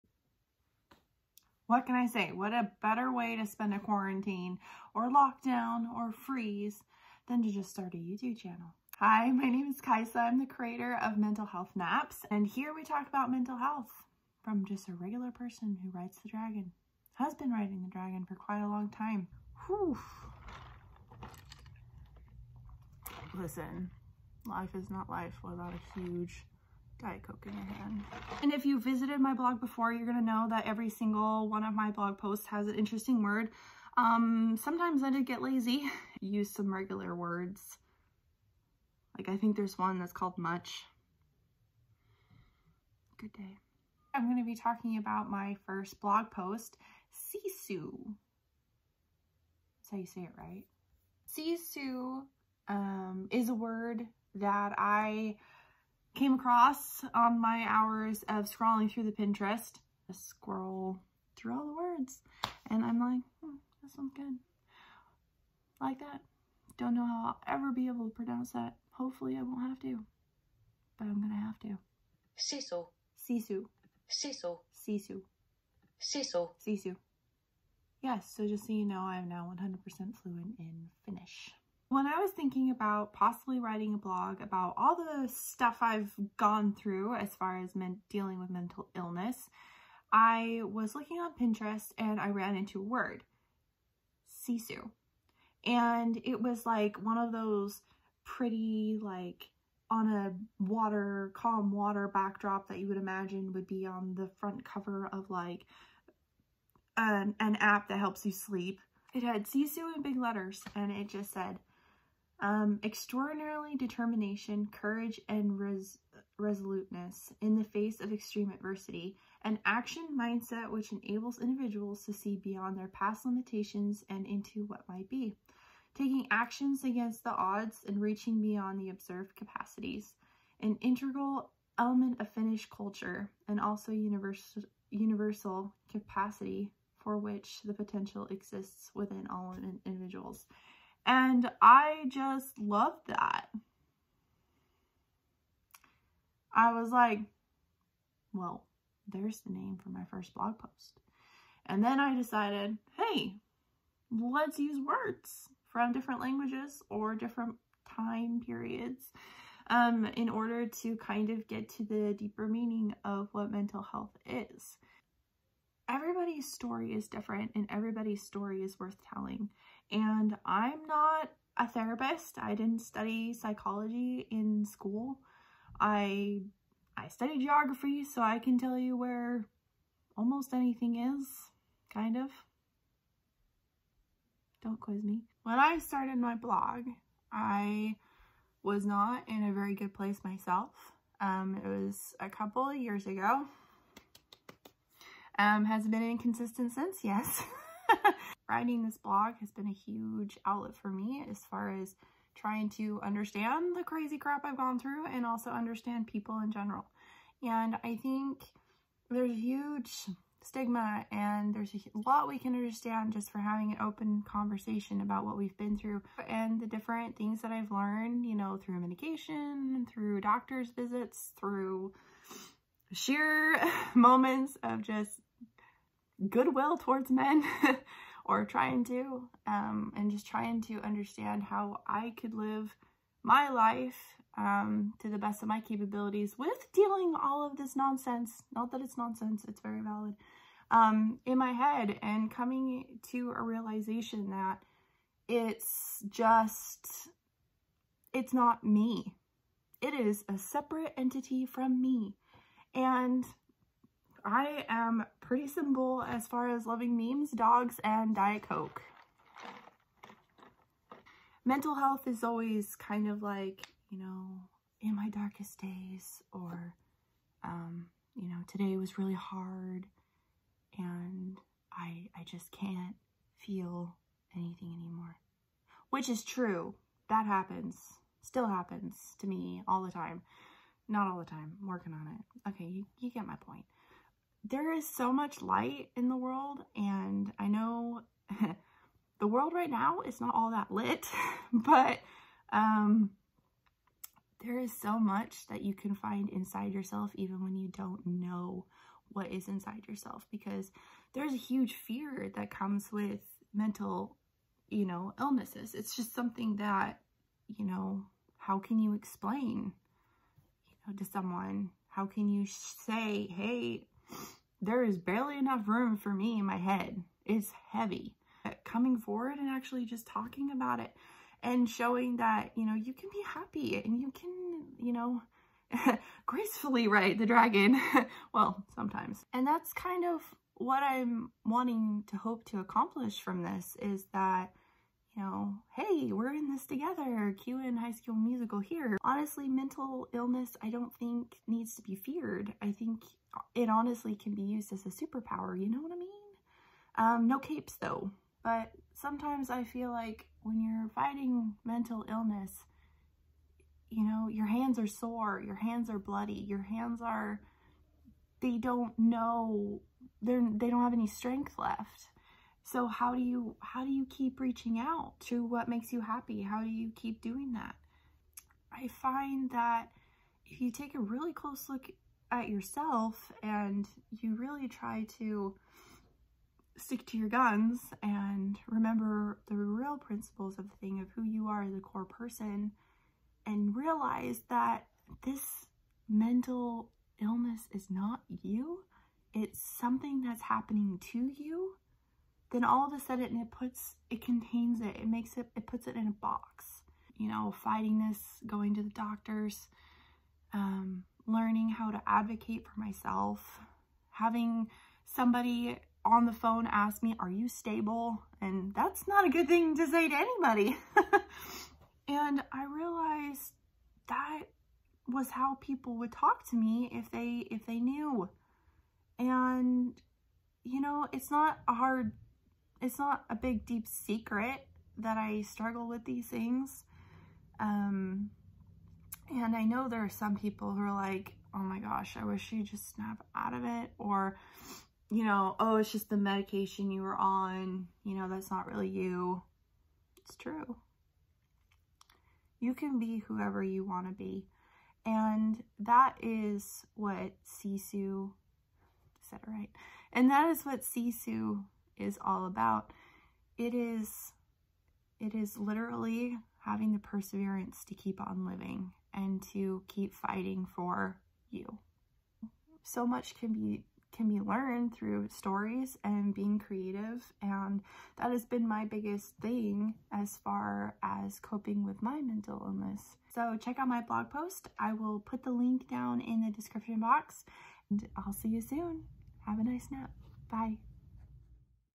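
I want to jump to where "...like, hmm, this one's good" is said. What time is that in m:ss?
1:02.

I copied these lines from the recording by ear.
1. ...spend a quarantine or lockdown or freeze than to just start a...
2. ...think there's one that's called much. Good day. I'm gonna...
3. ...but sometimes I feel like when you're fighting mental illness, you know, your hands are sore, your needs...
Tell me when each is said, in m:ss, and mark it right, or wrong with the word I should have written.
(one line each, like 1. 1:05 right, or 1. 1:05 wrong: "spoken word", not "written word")
1. 0:03 right
2. 0:39 right
3. 5:48 wrong: "hands", not "needs".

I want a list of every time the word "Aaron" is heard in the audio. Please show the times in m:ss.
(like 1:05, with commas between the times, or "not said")
not said.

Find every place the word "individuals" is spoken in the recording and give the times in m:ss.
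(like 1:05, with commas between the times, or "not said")
2:01, 2:19.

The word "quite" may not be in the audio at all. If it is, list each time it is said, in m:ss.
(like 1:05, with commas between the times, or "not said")
0:18.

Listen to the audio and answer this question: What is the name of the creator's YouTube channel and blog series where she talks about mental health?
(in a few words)
Mental Health Naps.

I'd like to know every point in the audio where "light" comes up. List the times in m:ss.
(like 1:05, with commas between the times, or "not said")
4:45.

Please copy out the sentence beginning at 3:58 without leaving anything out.
Not that it's nonsense, it's very valid.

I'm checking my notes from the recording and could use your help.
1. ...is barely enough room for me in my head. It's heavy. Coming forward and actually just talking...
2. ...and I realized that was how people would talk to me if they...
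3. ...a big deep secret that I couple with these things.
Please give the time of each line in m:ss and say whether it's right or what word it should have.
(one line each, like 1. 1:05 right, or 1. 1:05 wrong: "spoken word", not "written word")
1. 5:14 right
2. 6:52 right
3. 7:03 wrong: "struggle", not "couple".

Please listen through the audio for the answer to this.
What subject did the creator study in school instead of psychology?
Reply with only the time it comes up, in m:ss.
2:57.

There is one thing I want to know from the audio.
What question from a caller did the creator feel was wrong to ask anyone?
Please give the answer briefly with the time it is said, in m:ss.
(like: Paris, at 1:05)
Are you stable?, at 6:47.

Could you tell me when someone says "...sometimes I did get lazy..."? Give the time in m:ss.
0:34.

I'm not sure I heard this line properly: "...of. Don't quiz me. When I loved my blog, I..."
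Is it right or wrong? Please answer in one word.
wrong.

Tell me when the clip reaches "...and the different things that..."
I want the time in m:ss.
3:36.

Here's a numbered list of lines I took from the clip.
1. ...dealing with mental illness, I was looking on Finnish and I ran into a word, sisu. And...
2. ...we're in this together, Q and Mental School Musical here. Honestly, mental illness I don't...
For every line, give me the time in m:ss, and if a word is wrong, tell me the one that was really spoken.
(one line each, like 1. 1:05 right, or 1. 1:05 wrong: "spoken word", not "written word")
1. 1:28 wrong: "Pinterest", not "Finnish"
2. 5:36 wrong: "High", not "Mental".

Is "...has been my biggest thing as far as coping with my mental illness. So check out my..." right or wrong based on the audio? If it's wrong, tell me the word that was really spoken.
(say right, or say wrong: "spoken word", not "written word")
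right.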